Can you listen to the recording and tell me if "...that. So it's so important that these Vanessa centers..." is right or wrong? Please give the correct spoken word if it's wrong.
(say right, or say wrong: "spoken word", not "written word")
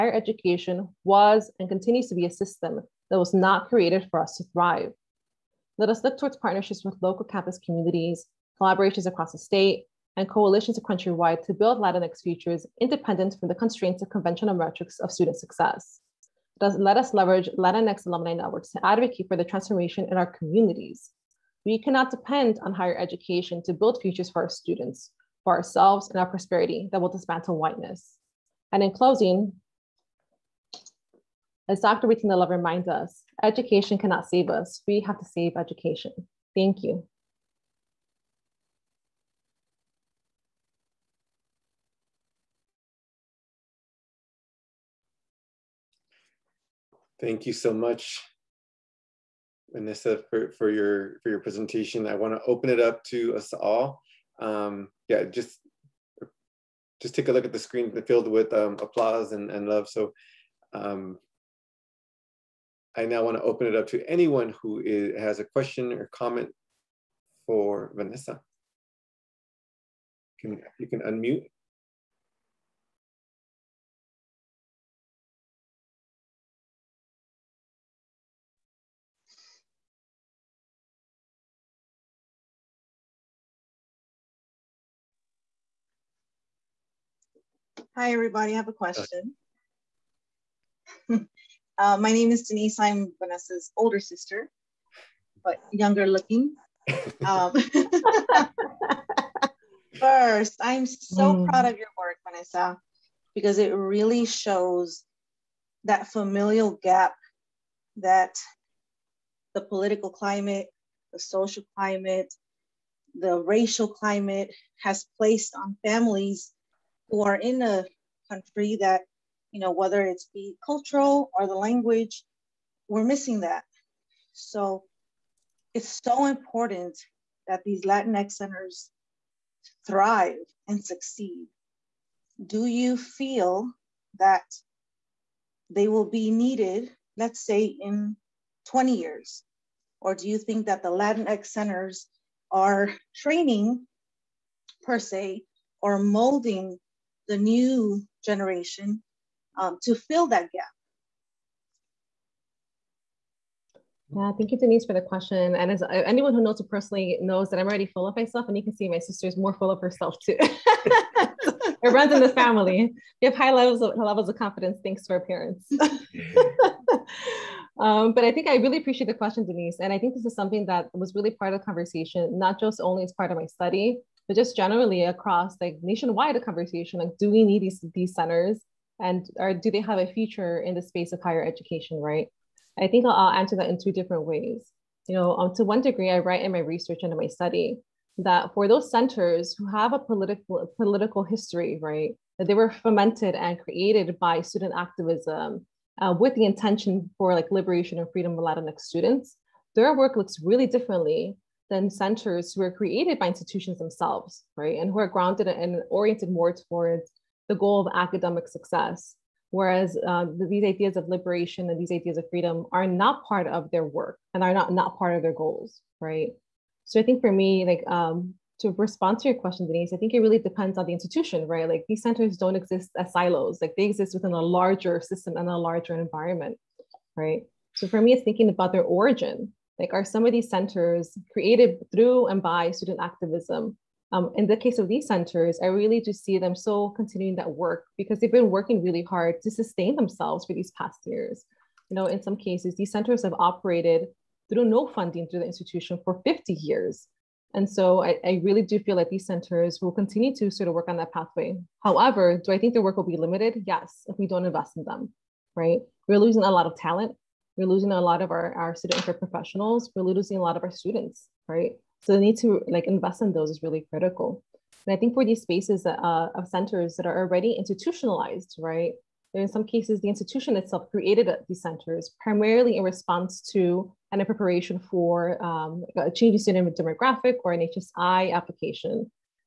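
wrong: "Latinx", not "Vanessa".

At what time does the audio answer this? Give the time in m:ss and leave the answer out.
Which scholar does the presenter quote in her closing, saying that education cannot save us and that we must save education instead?
0:31.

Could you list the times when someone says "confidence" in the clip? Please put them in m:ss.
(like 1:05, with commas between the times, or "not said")
2:44.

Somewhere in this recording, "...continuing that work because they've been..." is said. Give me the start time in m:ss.
3:56.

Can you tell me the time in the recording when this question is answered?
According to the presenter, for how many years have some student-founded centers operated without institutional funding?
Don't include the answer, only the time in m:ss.
4:06.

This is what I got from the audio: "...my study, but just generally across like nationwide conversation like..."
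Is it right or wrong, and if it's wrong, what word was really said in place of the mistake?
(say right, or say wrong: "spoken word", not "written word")
right.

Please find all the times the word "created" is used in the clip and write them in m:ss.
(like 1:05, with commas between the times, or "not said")
0:03, 3:13, 3:22, 3:51, 4:30.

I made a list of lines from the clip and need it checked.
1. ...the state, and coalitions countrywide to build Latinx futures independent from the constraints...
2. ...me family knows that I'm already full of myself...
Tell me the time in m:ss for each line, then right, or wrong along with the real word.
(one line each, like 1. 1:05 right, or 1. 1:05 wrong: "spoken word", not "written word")
1. 0:09 right
2. 2:36 wrong: "personally", not "family".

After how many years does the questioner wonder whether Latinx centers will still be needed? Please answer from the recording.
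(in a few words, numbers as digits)
20.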